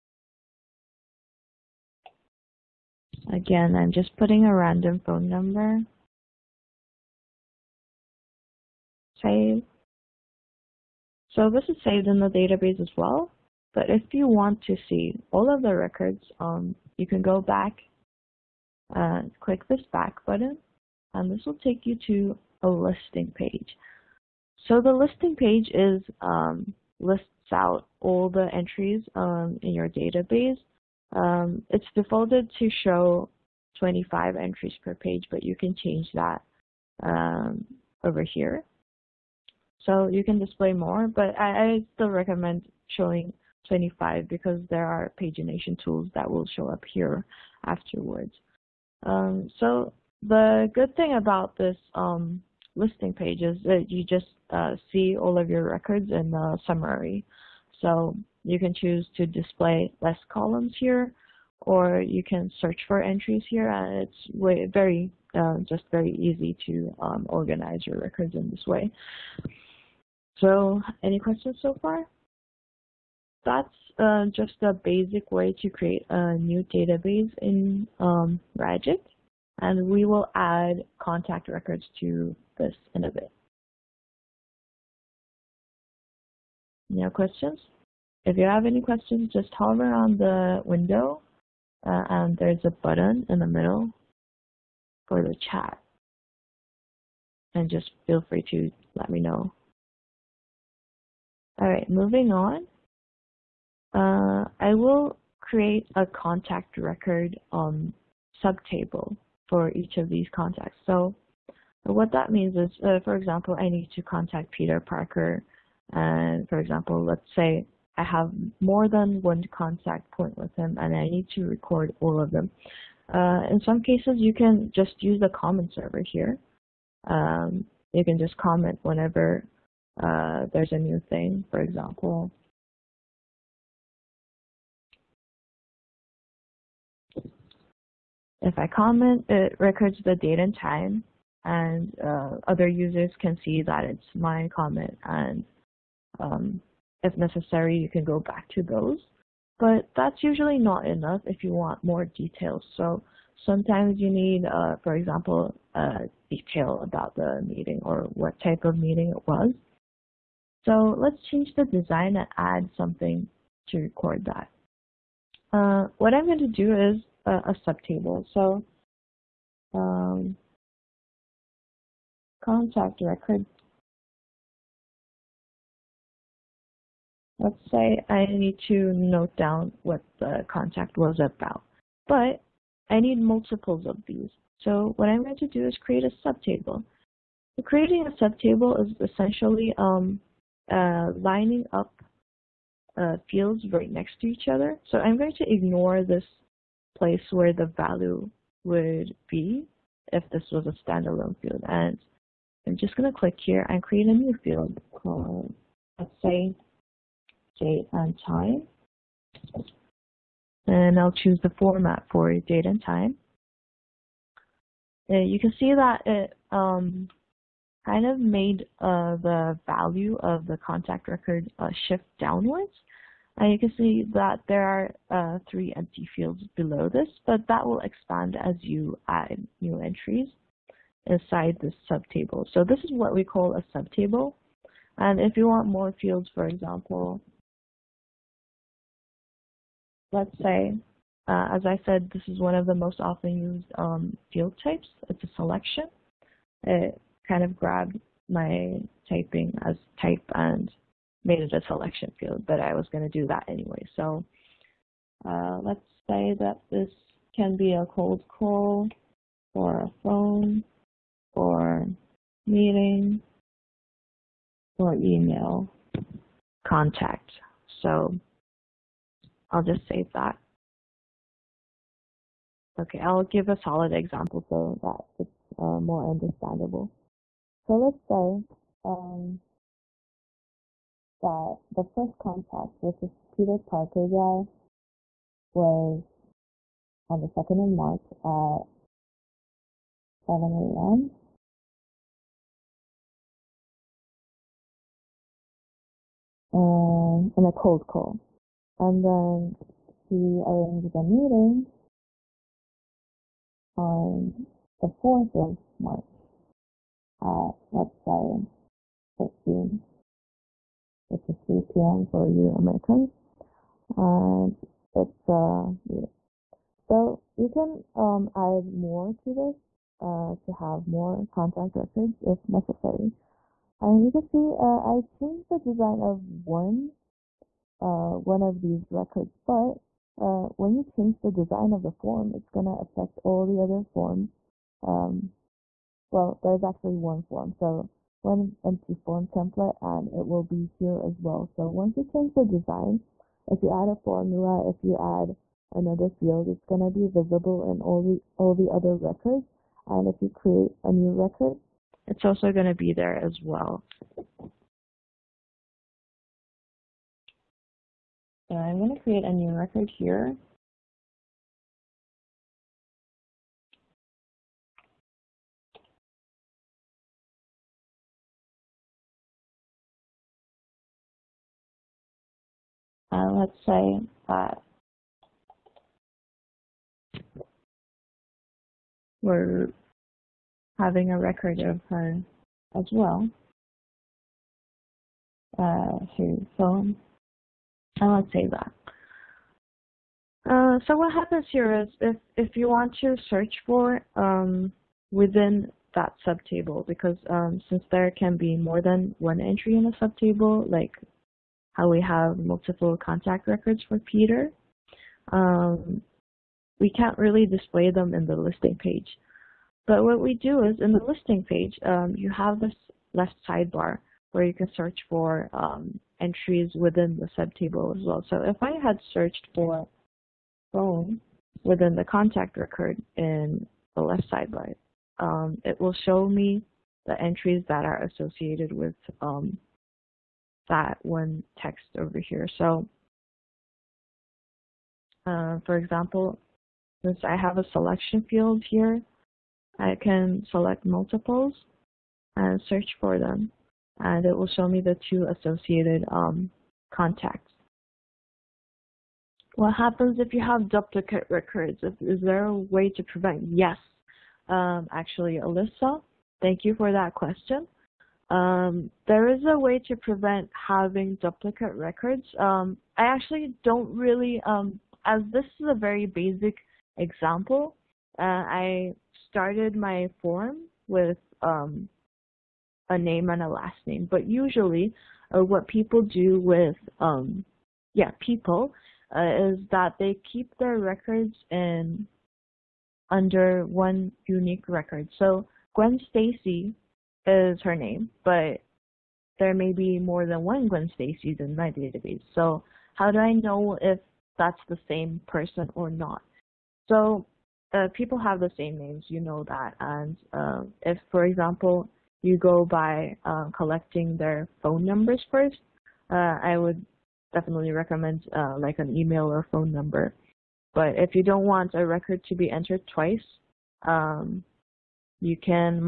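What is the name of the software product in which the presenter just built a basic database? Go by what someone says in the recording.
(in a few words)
Ragic.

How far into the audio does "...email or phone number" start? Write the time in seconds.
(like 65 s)
508 s.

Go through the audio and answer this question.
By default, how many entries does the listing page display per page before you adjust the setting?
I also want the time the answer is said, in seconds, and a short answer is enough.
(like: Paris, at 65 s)
25, at 33 s.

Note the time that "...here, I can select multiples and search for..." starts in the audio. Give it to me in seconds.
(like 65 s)
438 s.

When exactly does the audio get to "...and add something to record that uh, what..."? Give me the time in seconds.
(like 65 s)
162 s.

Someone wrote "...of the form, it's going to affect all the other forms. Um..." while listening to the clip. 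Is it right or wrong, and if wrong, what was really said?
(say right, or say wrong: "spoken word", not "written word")
right.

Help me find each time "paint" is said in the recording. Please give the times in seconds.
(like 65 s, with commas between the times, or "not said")
not said.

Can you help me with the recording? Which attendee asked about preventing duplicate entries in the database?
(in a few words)
Alyssa.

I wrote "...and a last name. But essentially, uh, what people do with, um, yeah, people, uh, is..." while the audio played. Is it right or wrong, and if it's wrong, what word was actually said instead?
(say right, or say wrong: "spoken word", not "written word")
wrong: "usually", not "essentially".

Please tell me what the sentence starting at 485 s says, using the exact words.
So Gwen Stacy is her name, but there may be more than one Gwen Stacy in my database.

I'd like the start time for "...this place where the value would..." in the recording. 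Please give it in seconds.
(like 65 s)
196 s.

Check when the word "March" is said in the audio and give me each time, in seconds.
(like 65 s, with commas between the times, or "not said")
287 s, 305 s.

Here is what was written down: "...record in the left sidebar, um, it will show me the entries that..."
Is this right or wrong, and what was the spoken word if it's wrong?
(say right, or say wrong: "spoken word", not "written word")
right.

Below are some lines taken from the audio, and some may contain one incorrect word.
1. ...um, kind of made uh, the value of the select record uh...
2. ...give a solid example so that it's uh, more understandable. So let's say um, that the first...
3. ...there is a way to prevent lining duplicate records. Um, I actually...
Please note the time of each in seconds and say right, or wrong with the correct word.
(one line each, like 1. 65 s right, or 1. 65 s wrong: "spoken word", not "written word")
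1. 216 s wrong: "contact", not "select"
2. 273 s right
3. 459 s wrong: "having", not "lining".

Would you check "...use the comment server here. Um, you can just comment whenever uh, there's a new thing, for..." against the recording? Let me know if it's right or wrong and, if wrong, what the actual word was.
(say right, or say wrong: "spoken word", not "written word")
right.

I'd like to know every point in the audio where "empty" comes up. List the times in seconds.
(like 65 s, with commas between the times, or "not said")
225 s, 338 s.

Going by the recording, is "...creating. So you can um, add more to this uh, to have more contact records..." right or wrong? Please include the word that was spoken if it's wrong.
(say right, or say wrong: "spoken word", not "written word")
wrong: "meeting", not "creating".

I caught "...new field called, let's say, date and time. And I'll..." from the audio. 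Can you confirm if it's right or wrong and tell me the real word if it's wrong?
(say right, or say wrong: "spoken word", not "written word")
right.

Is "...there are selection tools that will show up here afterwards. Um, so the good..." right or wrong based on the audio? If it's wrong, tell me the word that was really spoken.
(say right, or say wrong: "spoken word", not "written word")
wrong: "pagination", not "selection".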